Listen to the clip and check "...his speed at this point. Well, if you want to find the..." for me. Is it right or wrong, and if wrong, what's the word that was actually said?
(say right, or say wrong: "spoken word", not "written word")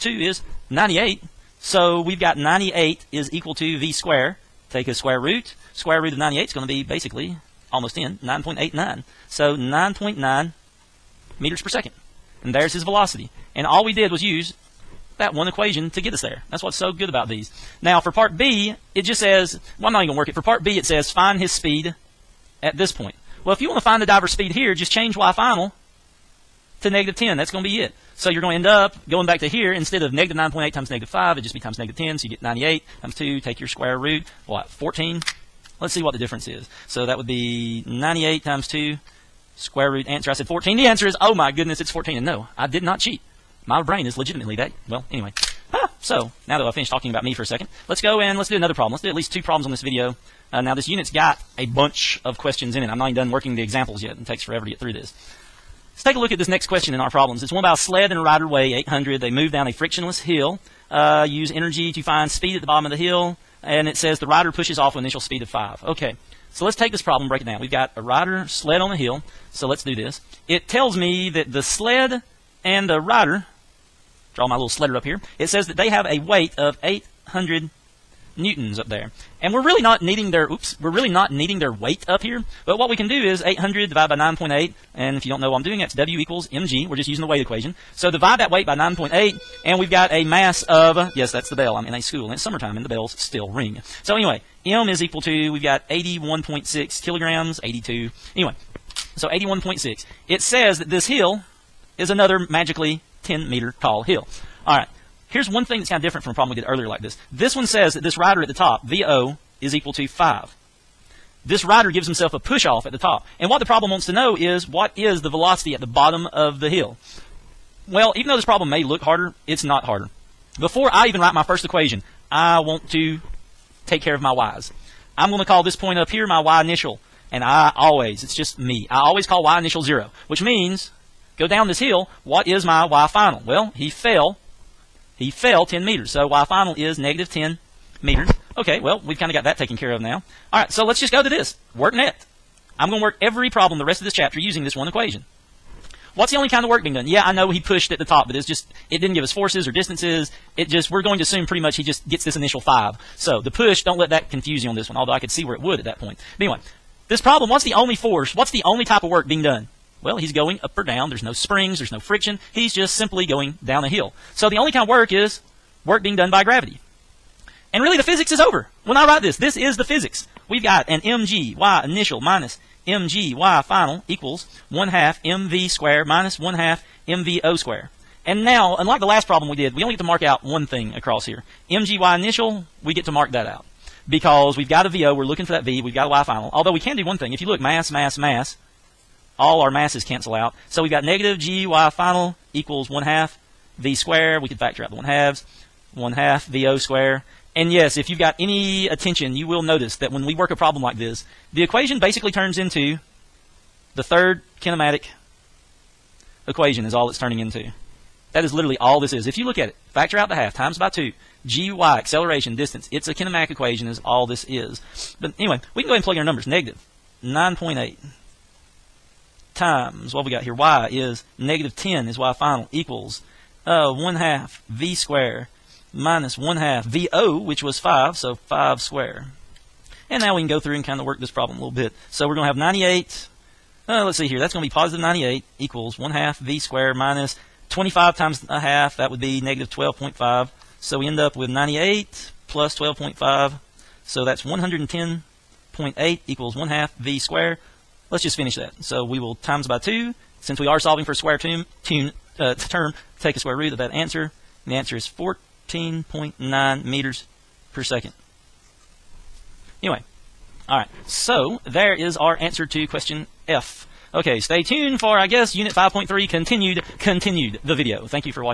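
right.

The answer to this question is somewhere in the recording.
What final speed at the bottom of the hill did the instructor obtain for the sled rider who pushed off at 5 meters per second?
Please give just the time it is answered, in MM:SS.
04:15.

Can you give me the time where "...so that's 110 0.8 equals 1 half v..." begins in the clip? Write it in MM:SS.
04:04.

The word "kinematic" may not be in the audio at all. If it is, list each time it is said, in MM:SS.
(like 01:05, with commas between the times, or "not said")
03:24, 03:33.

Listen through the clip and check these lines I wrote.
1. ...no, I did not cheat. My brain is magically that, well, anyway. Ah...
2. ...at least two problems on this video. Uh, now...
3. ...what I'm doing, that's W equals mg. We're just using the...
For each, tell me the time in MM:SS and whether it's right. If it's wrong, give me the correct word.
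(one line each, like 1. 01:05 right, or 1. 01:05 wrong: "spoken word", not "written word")
1. 00:42 wrong: "legitimately", not "magically"
2. 00:49 right
3. 01:25 right.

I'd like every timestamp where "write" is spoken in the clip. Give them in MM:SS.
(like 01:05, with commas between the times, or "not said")
02:01, 02:49.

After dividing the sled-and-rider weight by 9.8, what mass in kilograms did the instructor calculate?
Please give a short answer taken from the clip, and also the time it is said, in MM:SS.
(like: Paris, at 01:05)
81.6 kilograms, at 01:35.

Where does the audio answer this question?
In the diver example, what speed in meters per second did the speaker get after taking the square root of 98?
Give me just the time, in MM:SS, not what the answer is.
00:09.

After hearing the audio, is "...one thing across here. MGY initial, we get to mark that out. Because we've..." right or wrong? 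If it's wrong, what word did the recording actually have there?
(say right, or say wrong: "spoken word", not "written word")
right.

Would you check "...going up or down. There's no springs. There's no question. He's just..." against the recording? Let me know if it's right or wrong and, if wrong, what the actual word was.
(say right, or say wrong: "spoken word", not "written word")
wrong: "friction", not "question".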